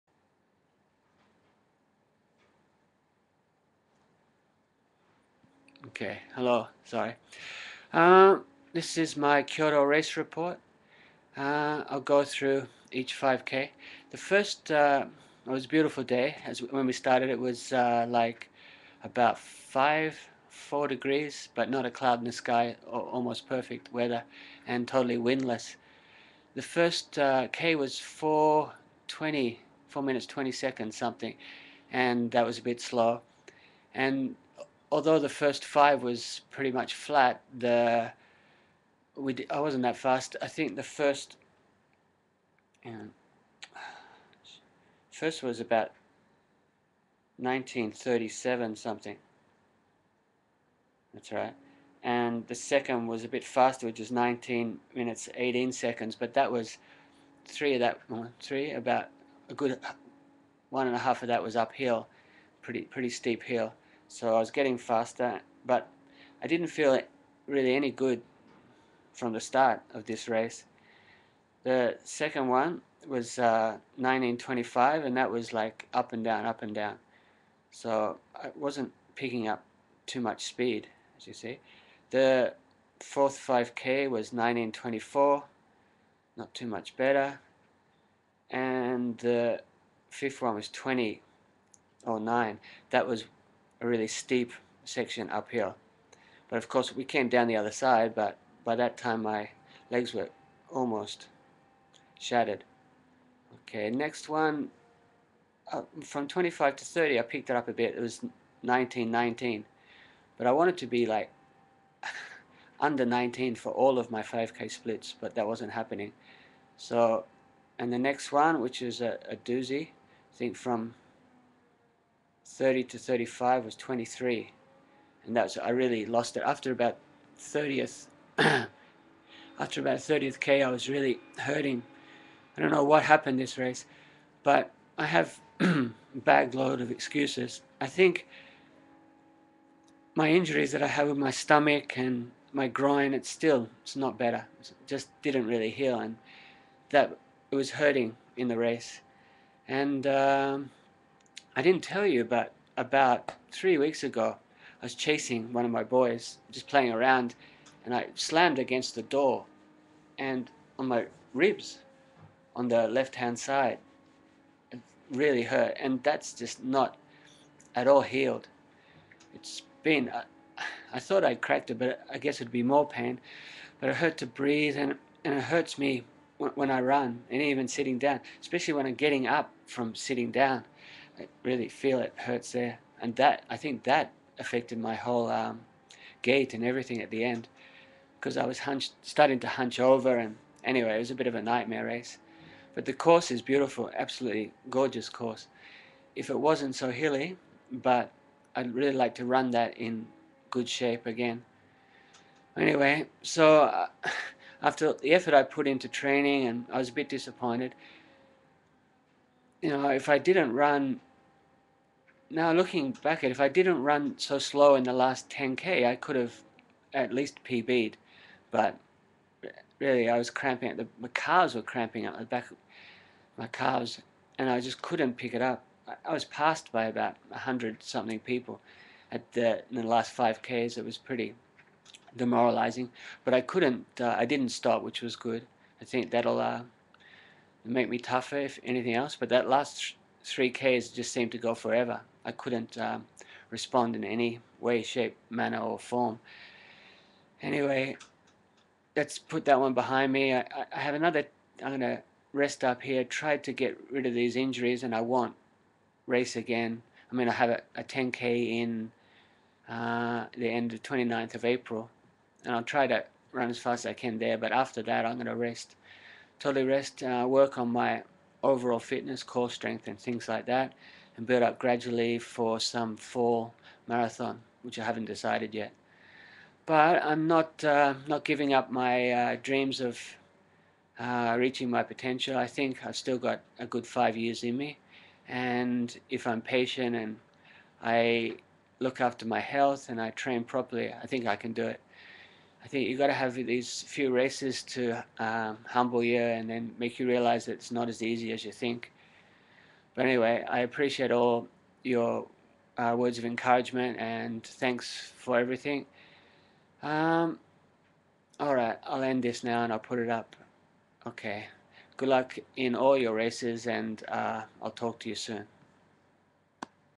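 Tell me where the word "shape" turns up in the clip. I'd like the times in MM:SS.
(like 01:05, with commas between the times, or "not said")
03:20, 04:04.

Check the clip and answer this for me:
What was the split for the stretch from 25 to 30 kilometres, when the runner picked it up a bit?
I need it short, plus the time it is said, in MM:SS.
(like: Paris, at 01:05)
19:19, at 01:48.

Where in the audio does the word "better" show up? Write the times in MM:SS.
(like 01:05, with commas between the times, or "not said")
01:26, 02:24.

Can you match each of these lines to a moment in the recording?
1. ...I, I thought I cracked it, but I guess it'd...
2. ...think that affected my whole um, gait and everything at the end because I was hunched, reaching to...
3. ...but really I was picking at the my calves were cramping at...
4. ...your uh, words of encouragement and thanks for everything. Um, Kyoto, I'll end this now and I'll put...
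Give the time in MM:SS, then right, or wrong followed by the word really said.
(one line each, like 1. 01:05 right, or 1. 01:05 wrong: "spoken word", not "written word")
1. 02:50 right
2. 03:03 wrong: "starting", not "reaching"
3. 03:38 wrong: "cramping", not "picking"
4. 05:01 wrong: "Alright", not "Kyoto".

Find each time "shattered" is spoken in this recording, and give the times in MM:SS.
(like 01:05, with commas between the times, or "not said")
01:42.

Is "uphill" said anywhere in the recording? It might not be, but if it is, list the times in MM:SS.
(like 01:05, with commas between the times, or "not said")
01:01, 01:35.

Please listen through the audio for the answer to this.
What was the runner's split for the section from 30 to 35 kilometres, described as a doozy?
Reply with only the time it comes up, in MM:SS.
02:03.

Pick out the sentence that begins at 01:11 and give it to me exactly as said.
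The second one was uh, 1925, and that was like up and down, up and down.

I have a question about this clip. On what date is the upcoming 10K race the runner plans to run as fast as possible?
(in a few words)
April 29.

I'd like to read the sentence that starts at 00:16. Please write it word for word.
As when we started, it was uh, like about five, four degrees, but not a cloud in the sky.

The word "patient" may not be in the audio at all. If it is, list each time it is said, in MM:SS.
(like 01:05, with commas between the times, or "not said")
04:46.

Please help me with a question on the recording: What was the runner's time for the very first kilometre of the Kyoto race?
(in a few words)
4:20.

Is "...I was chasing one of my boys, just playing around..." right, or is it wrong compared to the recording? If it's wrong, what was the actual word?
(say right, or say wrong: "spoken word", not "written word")
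right.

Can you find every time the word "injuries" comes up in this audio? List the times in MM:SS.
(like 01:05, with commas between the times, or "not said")
02:20, 04:14.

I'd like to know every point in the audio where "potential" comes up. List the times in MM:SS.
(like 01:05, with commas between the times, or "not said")
04:41.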